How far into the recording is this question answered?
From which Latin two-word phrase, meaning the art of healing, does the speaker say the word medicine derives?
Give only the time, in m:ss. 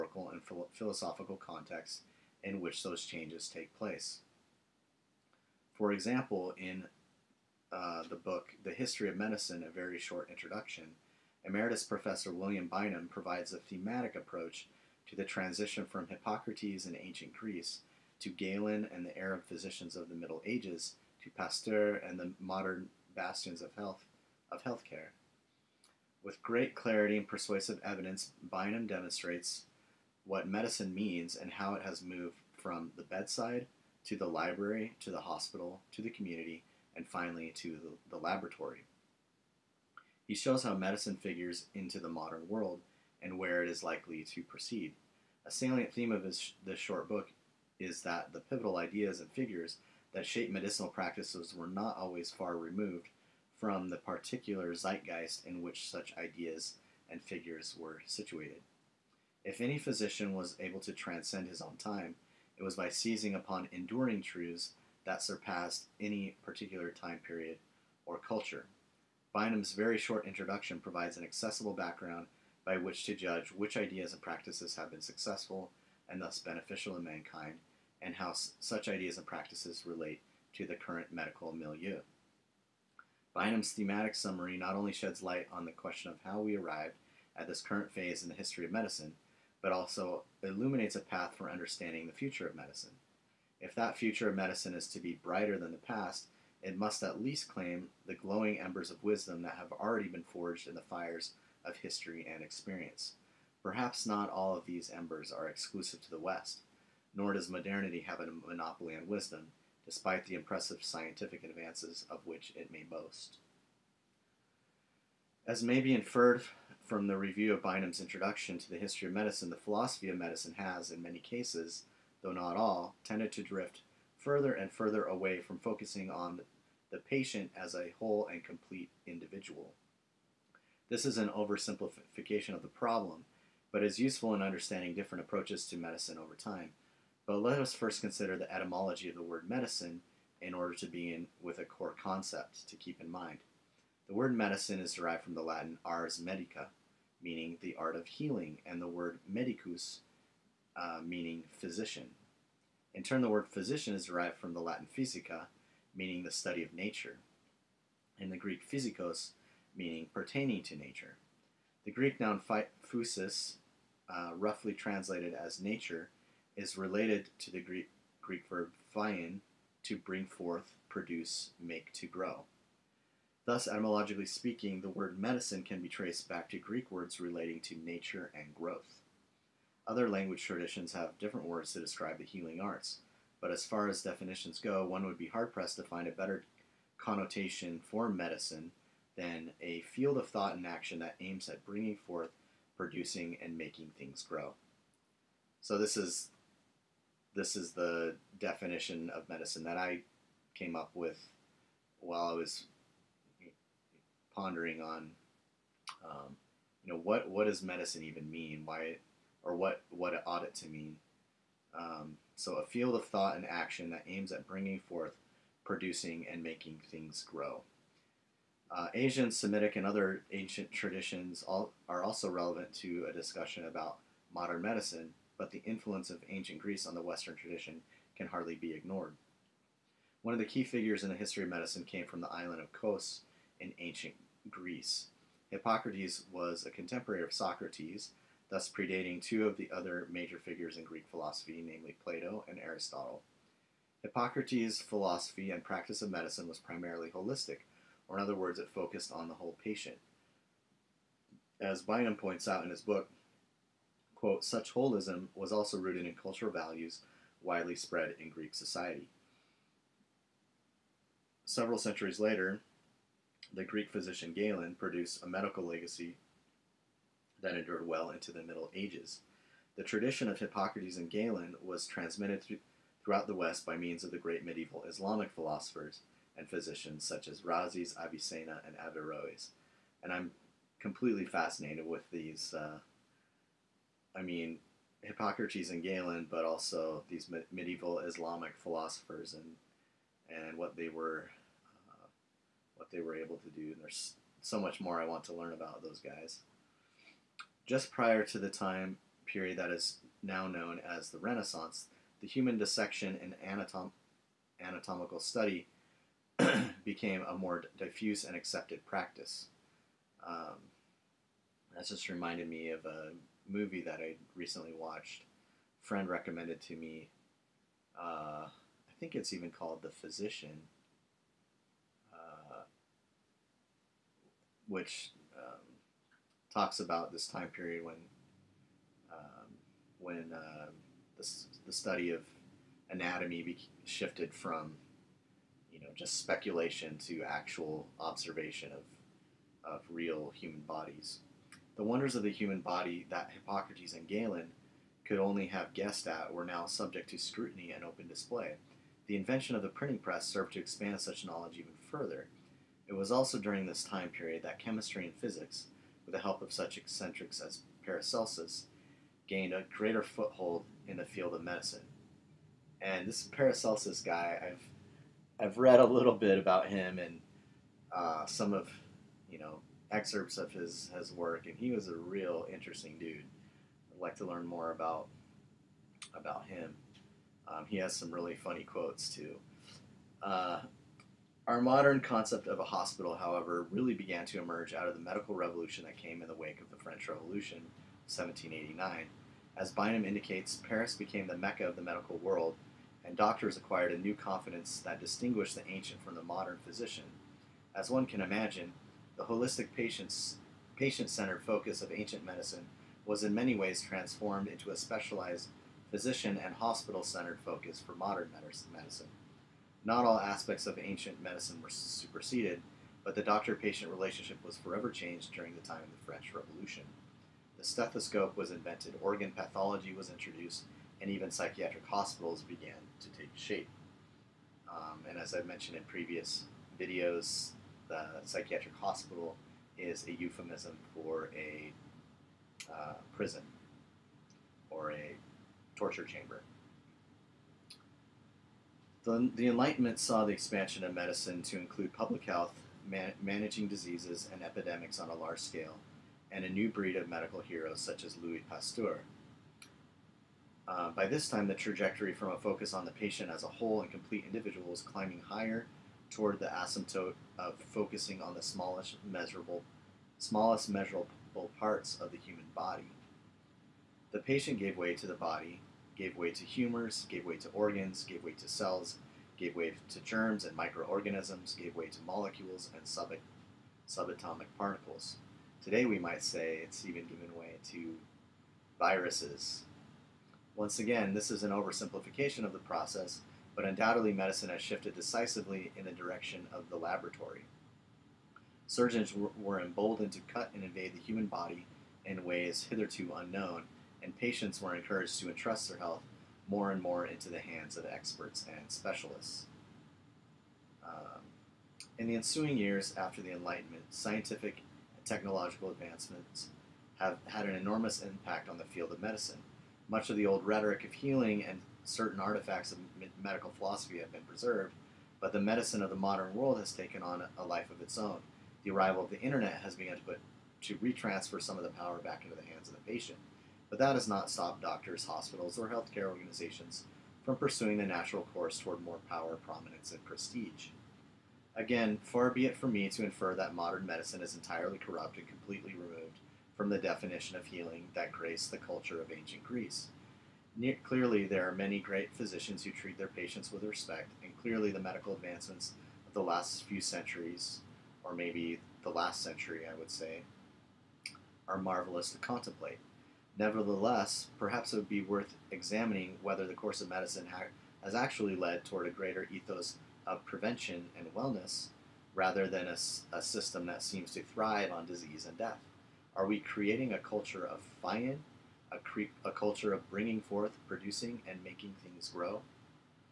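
2:25.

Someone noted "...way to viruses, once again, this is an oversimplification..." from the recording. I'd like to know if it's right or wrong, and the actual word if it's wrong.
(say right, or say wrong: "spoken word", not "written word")
right.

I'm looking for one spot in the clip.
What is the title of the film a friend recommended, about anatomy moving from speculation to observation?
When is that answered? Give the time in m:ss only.
5:19.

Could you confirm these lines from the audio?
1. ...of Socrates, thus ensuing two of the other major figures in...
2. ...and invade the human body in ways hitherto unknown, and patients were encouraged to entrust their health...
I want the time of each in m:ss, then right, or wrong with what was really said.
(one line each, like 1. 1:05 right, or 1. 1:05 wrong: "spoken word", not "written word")
1. 3:57 wrong: "predating", not "ensuing"
2. 8:10 right.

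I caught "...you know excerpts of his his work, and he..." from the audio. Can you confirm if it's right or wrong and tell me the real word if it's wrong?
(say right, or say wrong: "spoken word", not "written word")
right.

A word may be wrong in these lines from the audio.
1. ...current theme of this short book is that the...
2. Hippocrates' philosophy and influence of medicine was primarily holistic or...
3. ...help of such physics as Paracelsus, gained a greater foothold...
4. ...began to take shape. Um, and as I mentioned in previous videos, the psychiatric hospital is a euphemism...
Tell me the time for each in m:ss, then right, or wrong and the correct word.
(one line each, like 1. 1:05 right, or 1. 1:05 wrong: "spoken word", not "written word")
1. 0:45 wrong: "salient", not "current"
2. 4:04 wrong: "practice", not "influence"
3. 5:56 wrong: "eccentrics", not "physics"
4. 7:02 right.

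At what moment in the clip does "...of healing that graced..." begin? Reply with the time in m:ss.
8:57.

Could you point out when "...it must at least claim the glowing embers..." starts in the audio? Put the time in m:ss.
1:36.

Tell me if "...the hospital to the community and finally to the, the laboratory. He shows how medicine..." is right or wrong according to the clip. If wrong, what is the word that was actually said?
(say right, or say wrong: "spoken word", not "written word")
right.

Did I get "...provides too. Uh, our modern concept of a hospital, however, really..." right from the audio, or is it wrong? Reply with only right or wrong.
wrong.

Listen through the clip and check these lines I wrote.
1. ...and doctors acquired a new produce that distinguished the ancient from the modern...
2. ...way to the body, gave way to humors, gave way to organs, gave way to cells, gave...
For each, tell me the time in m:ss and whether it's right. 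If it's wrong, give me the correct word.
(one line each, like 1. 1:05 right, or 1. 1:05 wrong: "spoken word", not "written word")
1. 6:33 wrong: "confidence", not "produce"
2. 7:44 right.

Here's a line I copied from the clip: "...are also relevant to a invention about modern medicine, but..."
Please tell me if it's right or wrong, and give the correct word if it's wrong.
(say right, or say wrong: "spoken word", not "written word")
wrong: "discussion", not "invention".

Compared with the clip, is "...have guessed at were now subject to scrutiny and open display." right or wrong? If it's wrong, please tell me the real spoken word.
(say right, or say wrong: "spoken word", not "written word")
right.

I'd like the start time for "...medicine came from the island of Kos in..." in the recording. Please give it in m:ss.
3:51.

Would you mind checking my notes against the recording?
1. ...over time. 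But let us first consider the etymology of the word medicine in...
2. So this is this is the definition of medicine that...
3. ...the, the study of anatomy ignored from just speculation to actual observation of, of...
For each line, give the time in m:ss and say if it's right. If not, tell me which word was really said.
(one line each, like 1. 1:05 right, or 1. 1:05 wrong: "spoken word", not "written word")
1. 2:16 right
2. 3:15 right
3. 5:31 wrong: "shifted", not "ignored".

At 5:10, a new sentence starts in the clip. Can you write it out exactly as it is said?
Um, that's just reminded me of a movie that I recently watched.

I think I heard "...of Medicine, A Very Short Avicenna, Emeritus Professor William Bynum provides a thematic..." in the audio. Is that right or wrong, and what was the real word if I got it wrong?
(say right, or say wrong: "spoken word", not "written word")
wrong: "Introduction", not "Avicenna".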